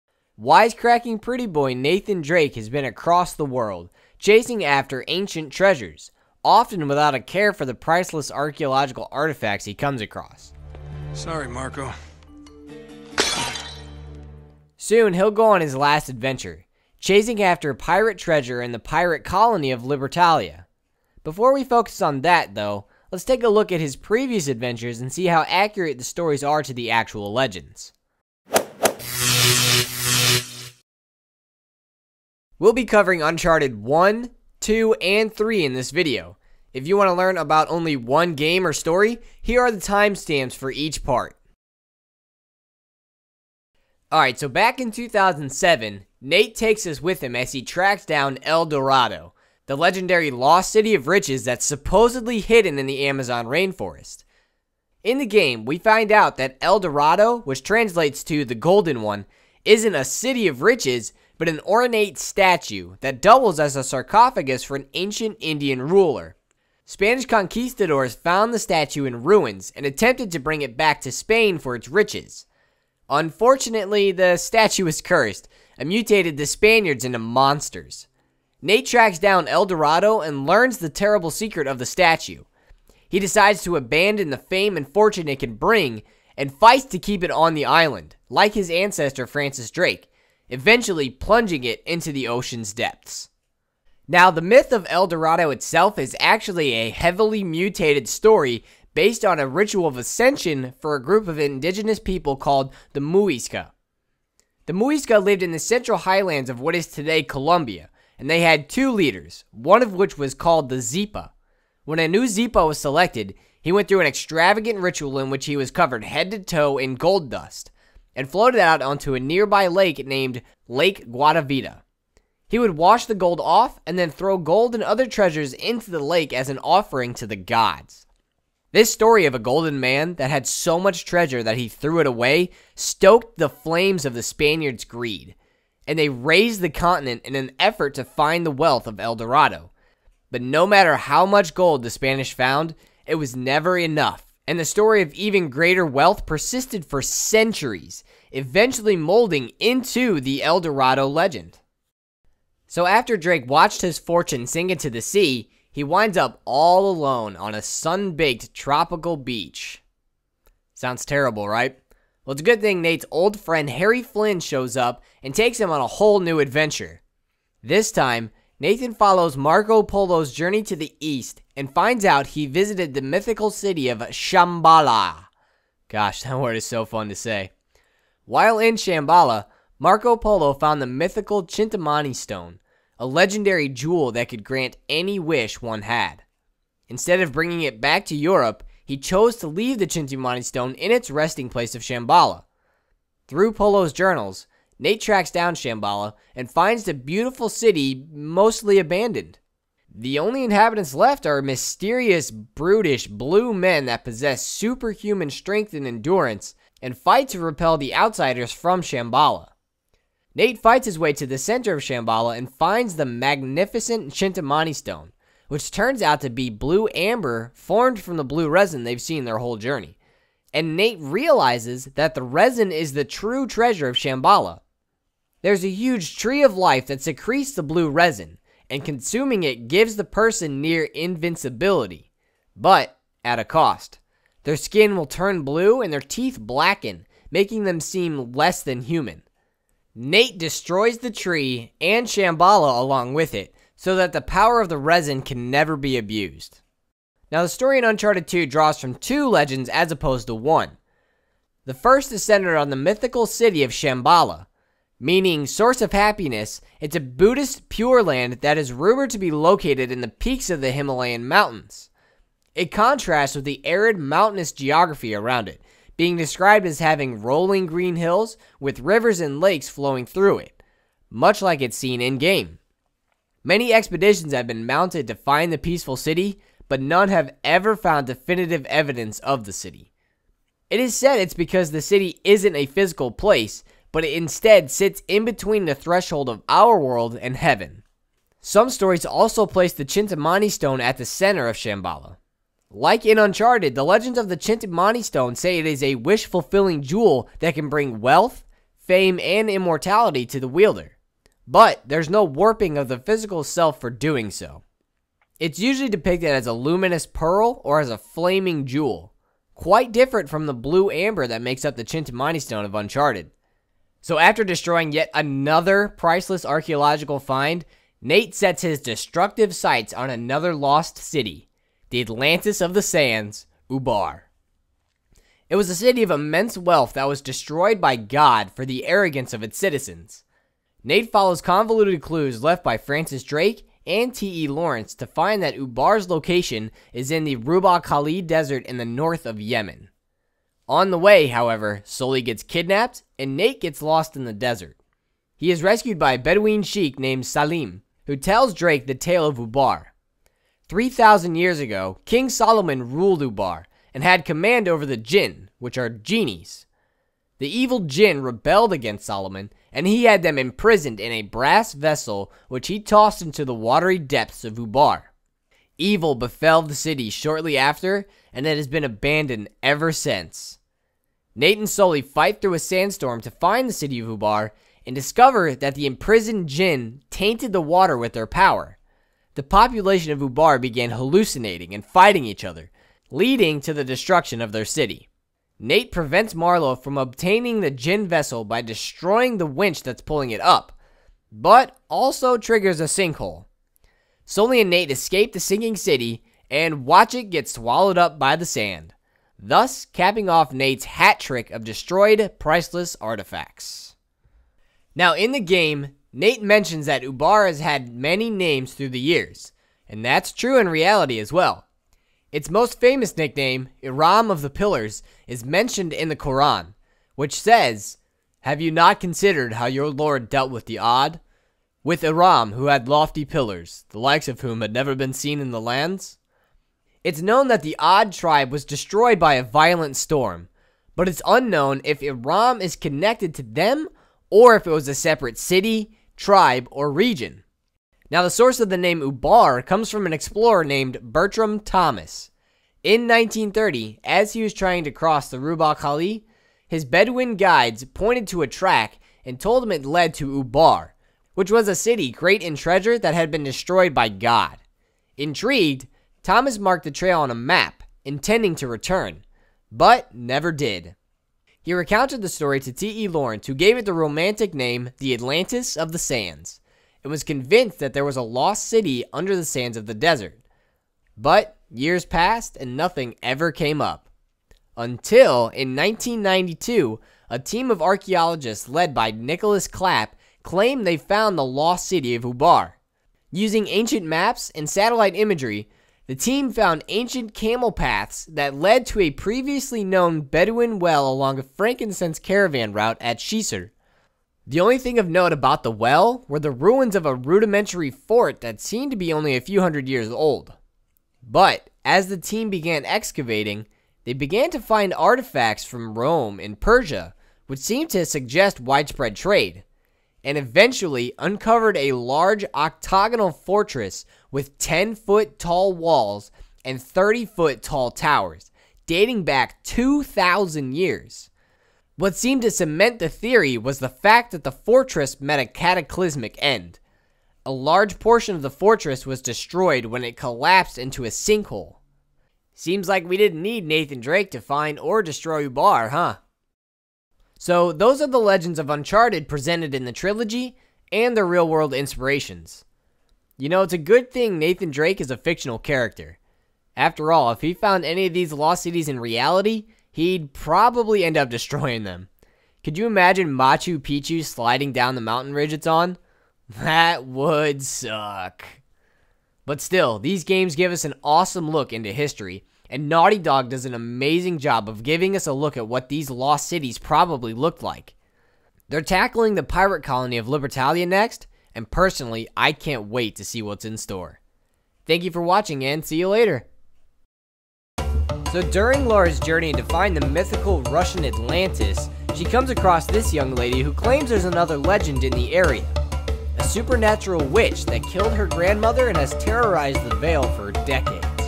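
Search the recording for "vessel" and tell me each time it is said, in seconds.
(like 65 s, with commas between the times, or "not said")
361 s, 388 s.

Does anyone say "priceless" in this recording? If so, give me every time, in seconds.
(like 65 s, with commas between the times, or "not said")
7 s, 315 s, 402 s.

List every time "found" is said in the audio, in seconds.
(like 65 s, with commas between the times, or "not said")
68 s, 142 s, 180 s, 277 s, 480 s, 486 s, 547 s.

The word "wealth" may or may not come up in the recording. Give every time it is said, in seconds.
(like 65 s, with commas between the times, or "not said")
138 s, 145 s, 297 s, 326 s.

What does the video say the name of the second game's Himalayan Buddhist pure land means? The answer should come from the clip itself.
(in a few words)
source of happiness.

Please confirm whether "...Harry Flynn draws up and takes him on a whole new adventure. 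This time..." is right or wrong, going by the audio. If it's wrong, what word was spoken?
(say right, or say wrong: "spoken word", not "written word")
wrong: "shows", not "draws".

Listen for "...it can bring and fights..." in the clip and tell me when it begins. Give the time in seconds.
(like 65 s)
85 s.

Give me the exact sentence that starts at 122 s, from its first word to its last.
He would wash the gold off and then throw gold and other treasures into the lake as an offering to the gods.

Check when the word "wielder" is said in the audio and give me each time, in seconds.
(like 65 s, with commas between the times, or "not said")
300 s.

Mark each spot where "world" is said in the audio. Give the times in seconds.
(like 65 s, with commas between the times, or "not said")
3 s, 286 s, 541 s.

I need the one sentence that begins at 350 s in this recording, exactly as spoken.
3,000 years ago, King Solomon ruled Ubar and had command over the jinn, which are genies.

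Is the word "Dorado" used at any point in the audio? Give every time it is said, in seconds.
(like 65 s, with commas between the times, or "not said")
48 s, 56 s, 79 s, 95 s, 139 s, 150 s.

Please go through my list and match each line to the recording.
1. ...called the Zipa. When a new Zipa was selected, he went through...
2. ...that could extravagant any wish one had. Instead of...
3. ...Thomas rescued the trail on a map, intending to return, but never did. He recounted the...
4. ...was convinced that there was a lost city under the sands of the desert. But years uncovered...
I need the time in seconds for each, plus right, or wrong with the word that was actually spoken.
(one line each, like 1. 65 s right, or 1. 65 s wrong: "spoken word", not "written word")
1. 110 s right
2. 184 s wrong: "grant", not "extravagant"
3. 456 s wrong: "marked", not "rescued"
4. 467 s wrong: "passed", not "uncovered".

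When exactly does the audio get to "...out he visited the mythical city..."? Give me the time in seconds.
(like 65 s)
172 s.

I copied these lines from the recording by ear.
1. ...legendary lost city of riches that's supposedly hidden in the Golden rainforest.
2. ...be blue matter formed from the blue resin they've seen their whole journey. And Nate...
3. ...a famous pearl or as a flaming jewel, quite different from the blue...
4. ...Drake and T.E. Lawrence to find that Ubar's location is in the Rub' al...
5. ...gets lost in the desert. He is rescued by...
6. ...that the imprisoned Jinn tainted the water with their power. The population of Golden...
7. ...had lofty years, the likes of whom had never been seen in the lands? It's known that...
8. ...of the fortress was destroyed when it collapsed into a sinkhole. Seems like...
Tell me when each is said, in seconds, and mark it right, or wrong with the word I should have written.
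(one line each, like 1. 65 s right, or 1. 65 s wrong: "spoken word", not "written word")
1. 49 s wrong: "Amazon", not "Golden"
2. 216 s wrong: "amber", not "matter"
3. 306 s wrong: "luminous", not "famous"
4. 333 s right
5. 343 s right
6. 375 s wrong: "Ubar", not "Golden"
7. 422 s wrong: "pillars", not "years"
8. 528 s right.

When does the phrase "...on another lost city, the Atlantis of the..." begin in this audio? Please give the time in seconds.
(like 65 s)
319 s.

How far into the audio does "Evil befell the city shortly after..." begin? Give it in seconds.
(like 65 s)
365 s.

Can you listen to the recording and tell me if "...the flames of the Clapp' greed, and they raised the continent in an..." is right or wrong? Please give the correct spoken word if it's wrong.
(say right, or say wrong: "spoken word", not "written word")
wrong: "Spaniards", not "Clapp".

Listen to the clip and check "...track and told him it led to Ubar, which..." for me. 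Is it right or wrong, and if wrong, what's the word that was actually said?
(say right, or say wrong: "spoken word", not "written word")
right.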